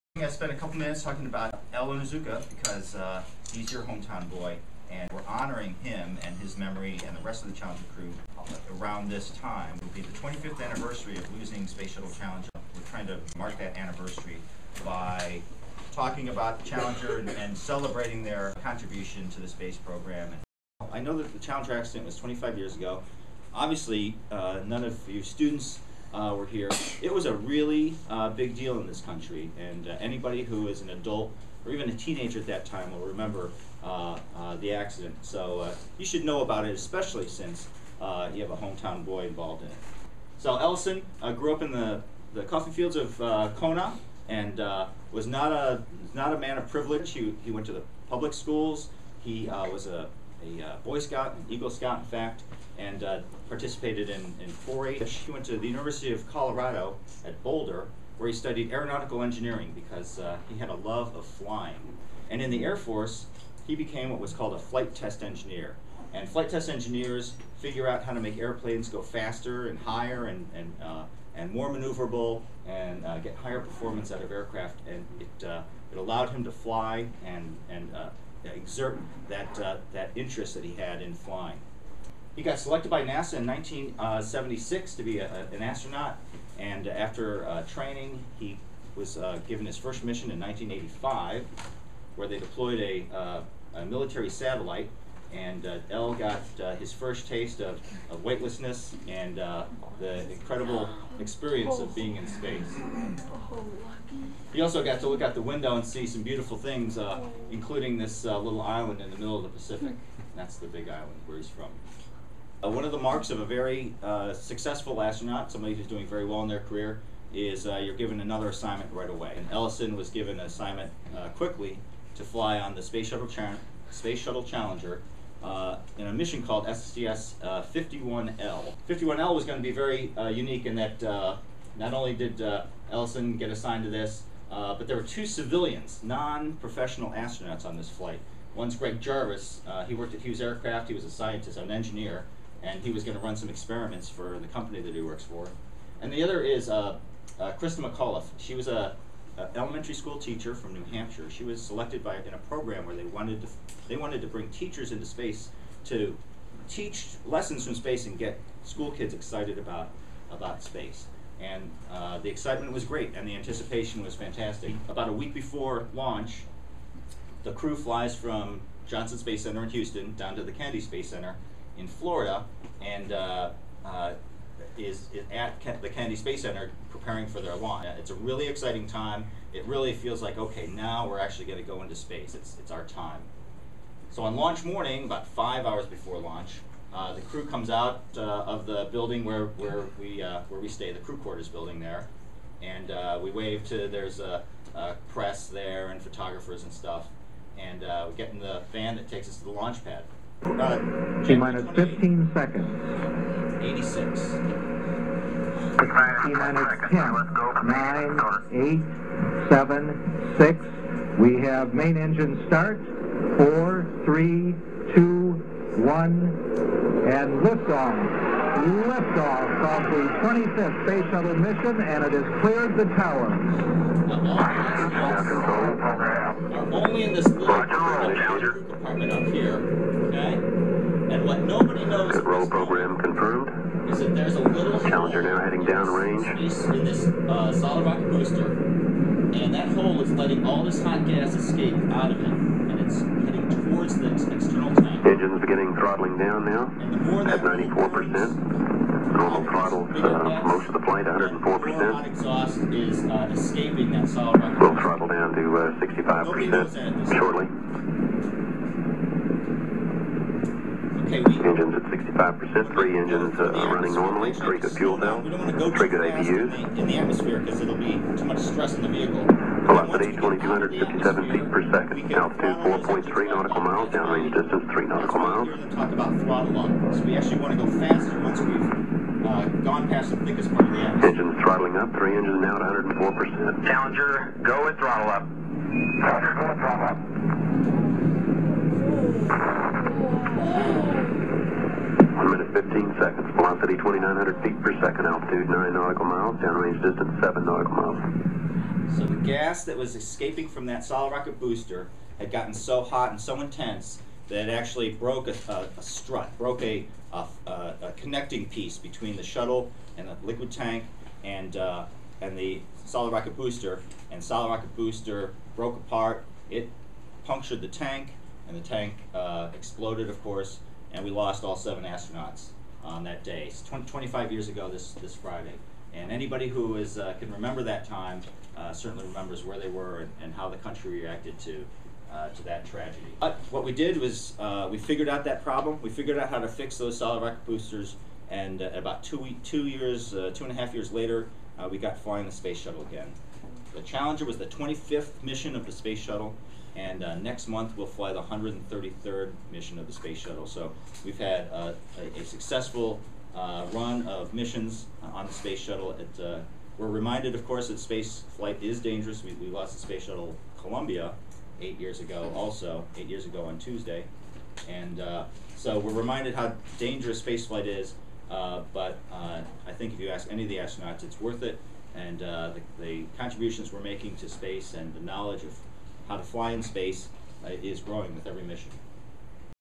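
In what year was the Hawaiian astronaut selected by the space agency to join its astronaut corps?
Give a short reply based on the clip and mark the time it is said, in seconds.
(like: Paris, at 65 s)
1976, at 83 s.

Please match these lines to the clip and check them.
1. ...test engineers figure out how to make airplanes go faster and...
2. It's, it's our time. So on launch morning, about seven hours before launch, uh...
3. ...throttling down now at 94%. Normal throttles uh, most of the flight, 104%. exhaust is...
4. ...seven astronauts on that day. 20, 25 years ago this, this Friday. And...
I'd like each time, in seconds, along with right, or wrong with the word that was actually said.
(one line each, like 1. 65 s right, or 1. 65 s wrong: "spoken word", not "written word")
1. 66 s right
2. 182 s wrong: "five", not "seven"
3. 245 s right
4. 321 s right.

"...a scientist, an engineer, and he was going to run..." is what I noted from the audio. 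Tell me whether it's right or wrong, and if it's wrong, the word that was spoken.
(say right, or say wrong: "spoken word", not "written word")
right.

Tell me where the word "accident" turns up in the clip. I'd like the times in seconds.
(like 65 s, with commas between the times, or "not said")
21 s, 34 s.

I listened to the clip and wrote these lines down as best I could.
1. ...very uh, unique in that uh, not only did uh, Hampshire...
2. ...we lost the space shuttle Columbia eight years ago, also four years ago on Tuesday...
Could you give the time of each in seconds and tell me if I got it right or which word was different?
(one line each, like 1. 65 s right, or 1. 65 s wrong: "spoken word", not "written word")
1. 129 s wrong: "Ellison", not "Hampshire"
2. 359 s wrong: "eight", not "four".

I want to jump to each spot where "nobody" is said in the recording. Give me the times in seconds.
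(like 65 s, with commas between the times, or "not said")
231 s.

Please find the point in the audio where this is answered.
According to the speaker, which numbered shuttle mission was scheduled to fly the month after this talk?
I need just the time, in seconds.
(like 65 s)
348 s.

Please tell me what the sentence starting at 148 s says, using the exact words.
She was a uh, elementary school teacher from New Hampshire.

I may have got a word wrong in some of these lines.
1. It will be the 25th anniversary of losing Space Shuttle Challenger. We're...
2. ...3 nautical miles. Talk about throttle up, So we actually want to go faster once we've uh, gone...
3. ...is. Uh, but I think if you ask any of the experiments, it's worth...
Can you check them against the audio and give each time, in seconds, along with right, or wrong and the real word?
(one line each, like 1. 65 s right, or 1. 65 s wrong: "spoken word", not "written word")
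1. 9 s right
2. 274 s right
3. 367 s wrong: "astronauts", not "experiments".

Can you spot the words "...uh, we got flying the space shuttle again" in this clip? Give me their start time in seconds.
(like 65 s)
341 s.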